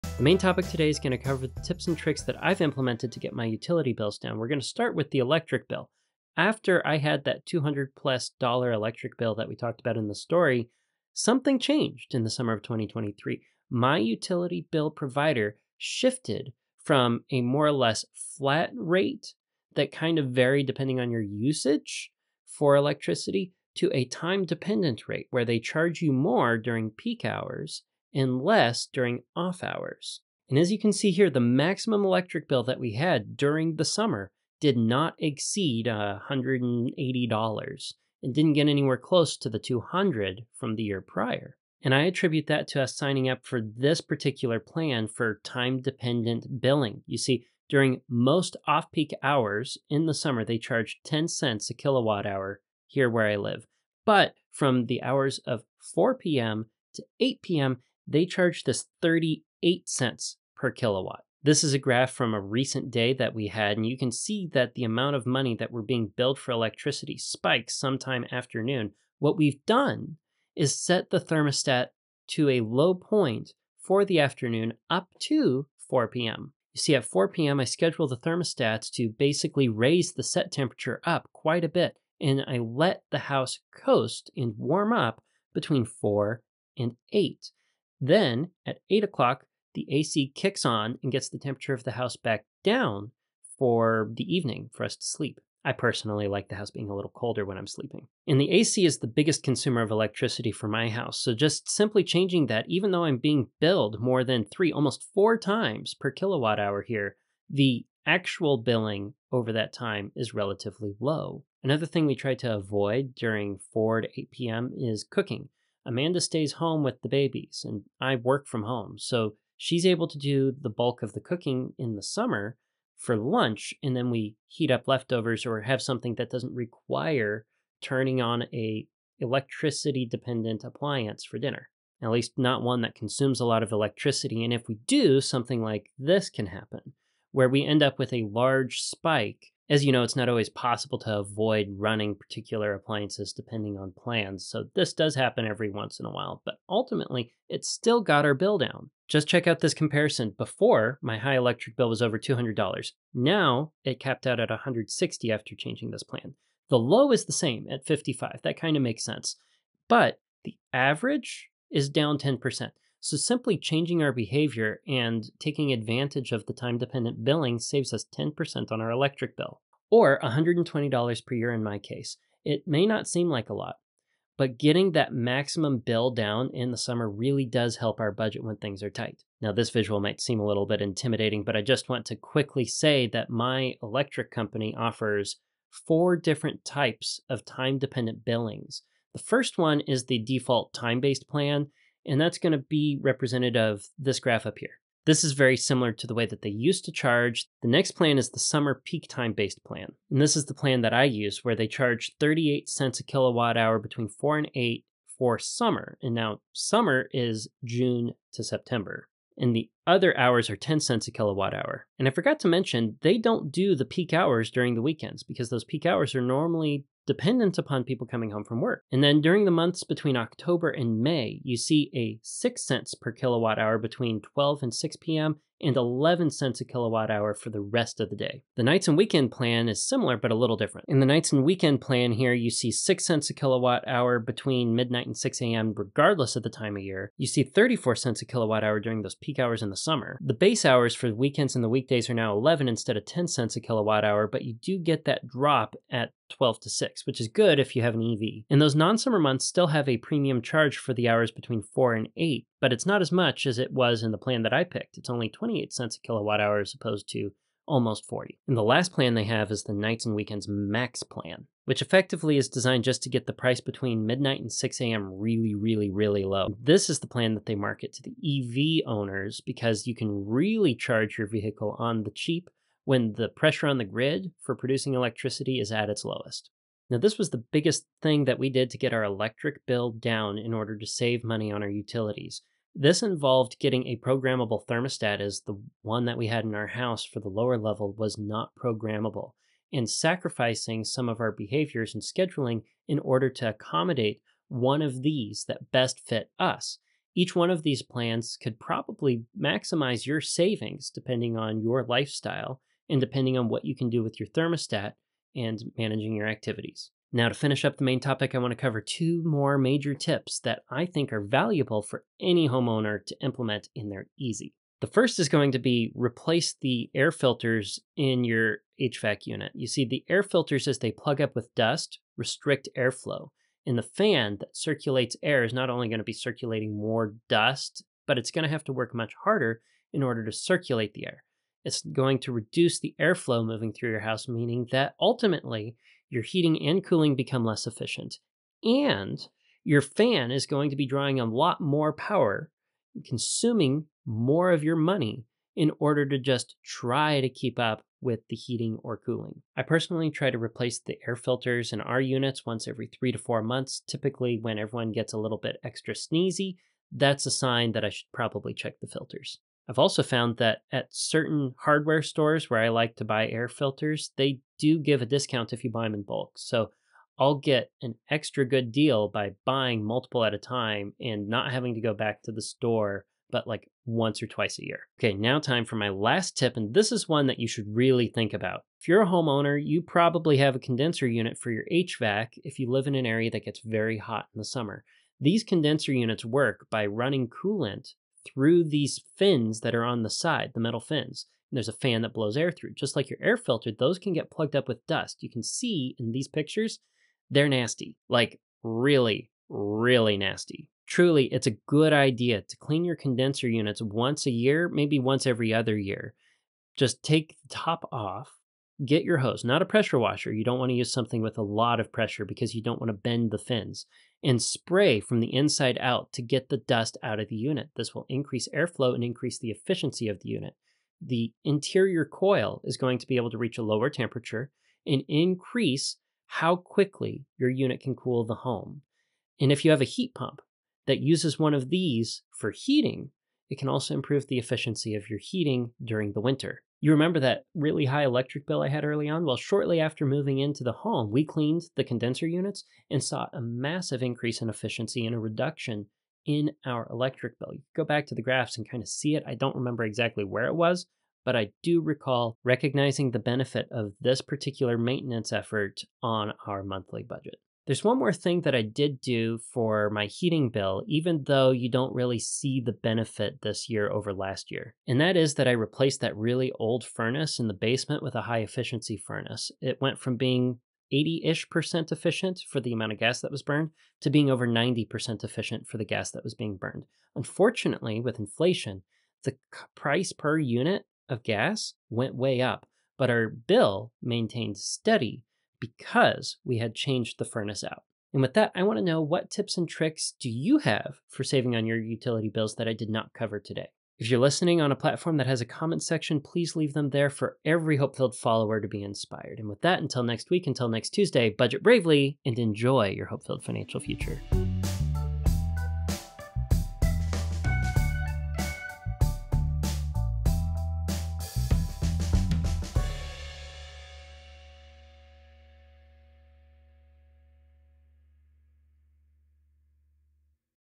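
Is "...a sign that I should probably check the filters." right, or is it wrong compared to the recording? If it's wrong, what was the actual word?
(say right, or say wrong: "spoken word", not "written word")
right.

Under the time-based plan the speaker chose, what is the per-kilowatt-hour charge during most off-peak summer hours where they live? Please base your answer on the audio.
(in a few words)
10 cents.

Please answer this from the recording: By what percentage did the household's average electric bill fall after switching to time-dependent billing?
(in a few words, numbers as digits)
10%.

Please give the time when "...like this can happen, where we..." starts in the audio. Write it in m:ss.
2:15.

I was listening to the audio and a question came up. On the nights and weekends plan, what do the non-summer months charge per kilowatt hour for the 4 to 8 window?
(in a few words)
28 cents.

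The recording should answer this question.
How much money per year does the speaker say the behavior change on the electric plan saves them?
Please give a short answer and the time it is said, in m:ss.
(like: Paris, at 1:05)
$120, at 2:50.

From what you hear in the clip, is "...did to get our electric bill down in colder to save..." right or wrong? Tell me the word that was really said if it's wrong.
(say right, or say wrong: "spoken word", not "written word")
wrong: "order", not "colder".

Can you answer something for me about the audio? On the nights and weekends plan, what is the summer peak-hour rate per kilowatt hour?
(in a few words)
34 cents.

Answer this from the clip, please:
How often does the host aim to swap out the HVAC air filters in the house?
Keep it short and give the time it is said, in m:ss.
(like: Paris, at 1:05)
Every 3 to 4 months, at 5:52.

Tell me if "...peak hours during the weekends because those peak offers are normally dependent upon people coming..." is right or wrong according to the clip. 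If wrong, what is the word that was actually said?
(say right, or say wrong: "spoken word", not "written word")
wrong: "hours", not "offers".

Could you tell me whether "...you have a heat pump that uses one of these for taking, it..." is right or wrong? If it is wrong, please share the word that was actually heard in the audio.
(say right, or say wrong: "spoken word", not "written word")
wrong: "heating", not "taking".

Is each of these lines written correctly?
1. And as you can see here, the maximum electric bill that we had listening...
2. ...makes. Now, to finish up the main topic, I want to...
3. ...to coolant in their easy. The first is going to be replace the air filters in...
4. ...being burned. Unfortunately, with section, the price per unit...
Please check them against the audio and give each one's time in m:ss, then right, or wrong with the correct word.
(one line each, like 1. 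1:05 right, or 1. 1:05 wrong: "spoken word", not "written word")
1. 0:30 wrong: "during", not "listening"
2. 5:06 wrong: "activities", not "makes"
3. 5:13 wrong: "implement", not "coolant"
4. 7:56 wrong: "inflation", not "section".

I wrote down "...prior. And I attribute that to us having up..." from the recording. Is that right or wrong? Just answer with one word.
wrong.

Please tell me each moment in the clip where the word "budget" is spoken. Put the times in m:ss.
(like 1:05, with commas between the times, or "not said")
2:58, 7:37, 8:21.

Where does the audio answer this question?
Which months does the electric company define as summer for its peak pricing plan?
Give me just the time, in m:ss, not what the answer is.
3:27.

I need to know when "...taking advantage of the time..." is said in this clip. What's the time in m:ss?
2:45.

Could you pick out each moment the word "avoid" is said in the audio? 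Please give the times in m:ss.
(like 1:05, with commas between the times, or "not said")
1:52, 2:21.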